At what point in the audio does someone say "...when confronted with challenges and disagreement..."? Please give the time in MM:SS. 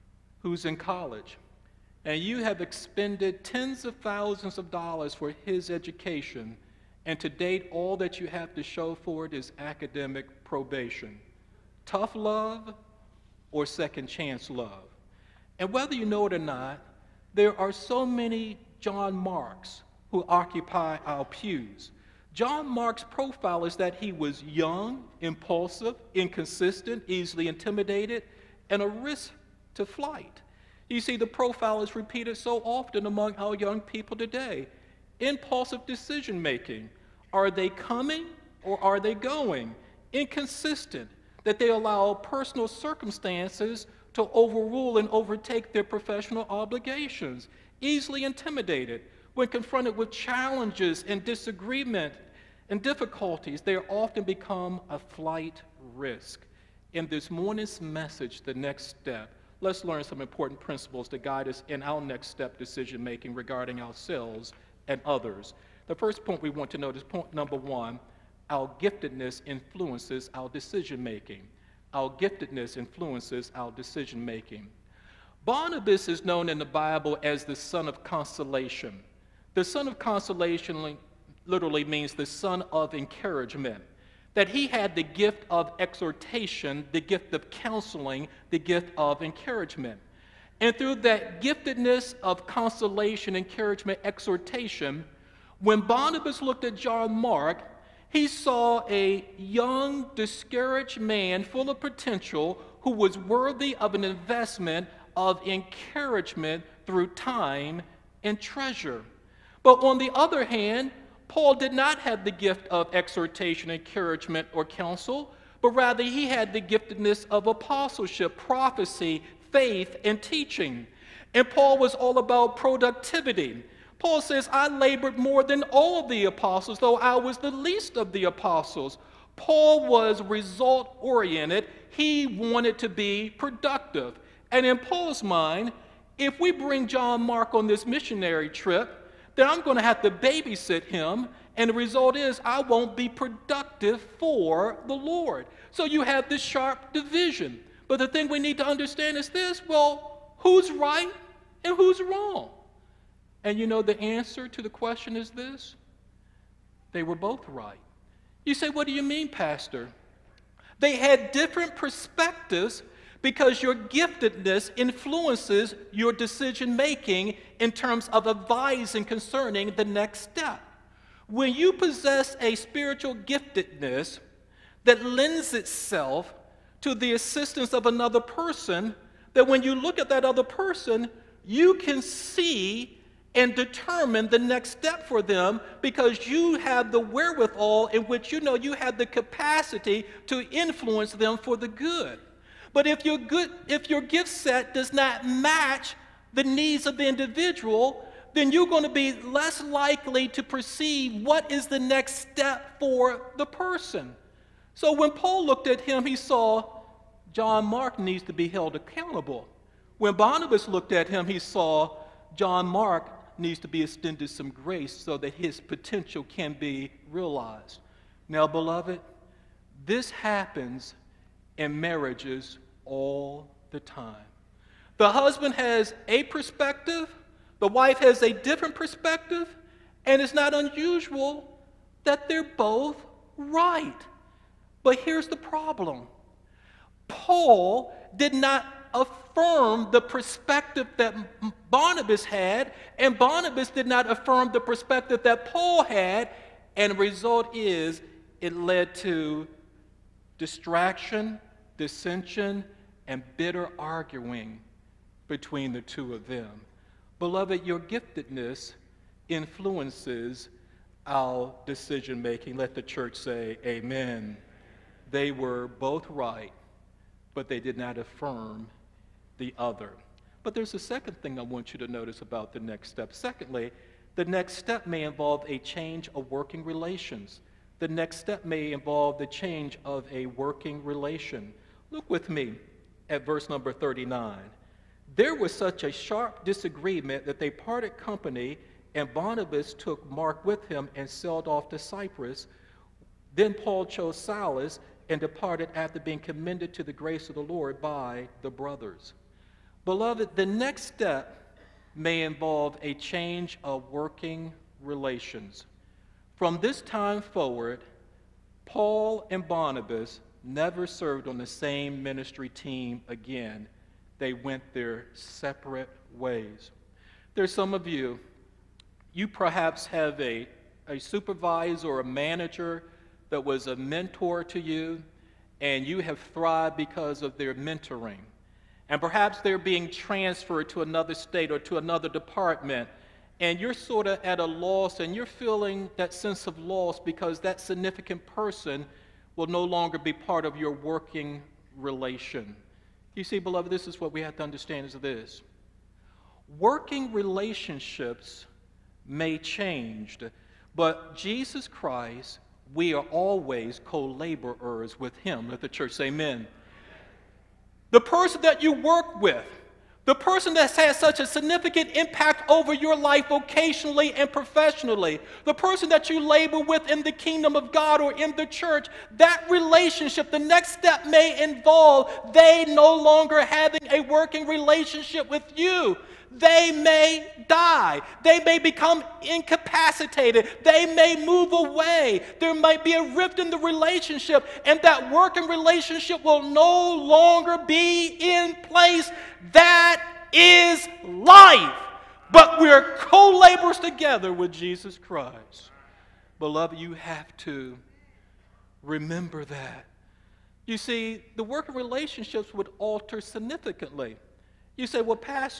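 00:49.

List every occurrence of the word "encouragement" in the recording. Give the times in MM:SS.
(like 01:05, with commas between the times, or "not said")
01:22, 01:29, 01:33, 01:45, 01:53.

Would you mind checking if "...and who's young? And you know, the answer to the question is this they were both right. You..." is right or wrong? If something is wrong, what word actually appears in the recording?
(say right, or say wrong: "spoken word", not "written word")
wrong: "wrong", not "young".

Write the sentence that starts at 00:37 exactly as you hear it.
Are they coming or are they going?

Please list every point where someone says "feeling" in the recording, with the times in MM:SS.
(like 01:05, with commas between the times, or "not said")
05:35.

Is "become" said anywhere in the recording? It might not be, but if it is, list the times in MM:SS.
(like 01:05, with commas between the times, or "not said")
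00:54, 06:18.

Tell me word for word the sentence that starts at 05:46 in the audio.
Working relationships may change, but Jesus Christ, we are always co-laborers with him.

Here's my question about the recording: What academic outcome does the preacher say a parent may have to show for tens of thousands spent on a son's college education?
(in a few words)
Academic probation.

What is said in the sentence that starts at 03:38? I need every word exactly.
Now, beloved, this happens in marriages all the time.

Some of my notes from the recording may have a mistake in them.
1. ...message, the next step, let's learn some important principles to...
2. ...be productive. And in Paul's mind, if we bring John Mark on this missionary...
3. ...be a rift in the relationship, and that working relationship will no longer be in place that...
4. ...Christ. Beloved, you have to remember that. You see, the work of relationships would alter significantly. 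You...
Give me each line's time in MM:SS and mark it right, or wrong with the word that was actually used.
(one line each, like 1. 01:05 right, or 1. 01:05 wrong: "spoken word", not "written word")
1. 00:57 right
2. 02:12 right
3. 06:22 right
4. 06:34 right.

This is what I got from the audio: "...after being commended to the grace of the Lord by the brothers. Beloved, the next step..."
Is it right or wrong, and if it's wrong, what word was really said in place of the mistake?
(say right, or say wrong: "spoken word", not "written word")
right.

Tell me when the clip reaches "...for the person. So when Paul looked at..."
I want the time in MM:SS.
03:22.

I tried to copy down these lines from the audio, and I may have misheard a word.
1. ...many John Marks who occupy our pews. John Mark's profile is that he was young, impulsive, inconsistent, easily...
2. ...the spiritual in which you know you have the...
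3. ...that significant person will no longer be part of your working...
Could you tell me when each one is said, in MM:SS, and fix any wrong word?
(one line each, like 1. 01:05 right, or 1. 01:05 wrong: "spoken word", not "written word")
1. 00:18 right
2. 03:06 wrong: "wherewithal", not "spiritual"
3. 05:37 right.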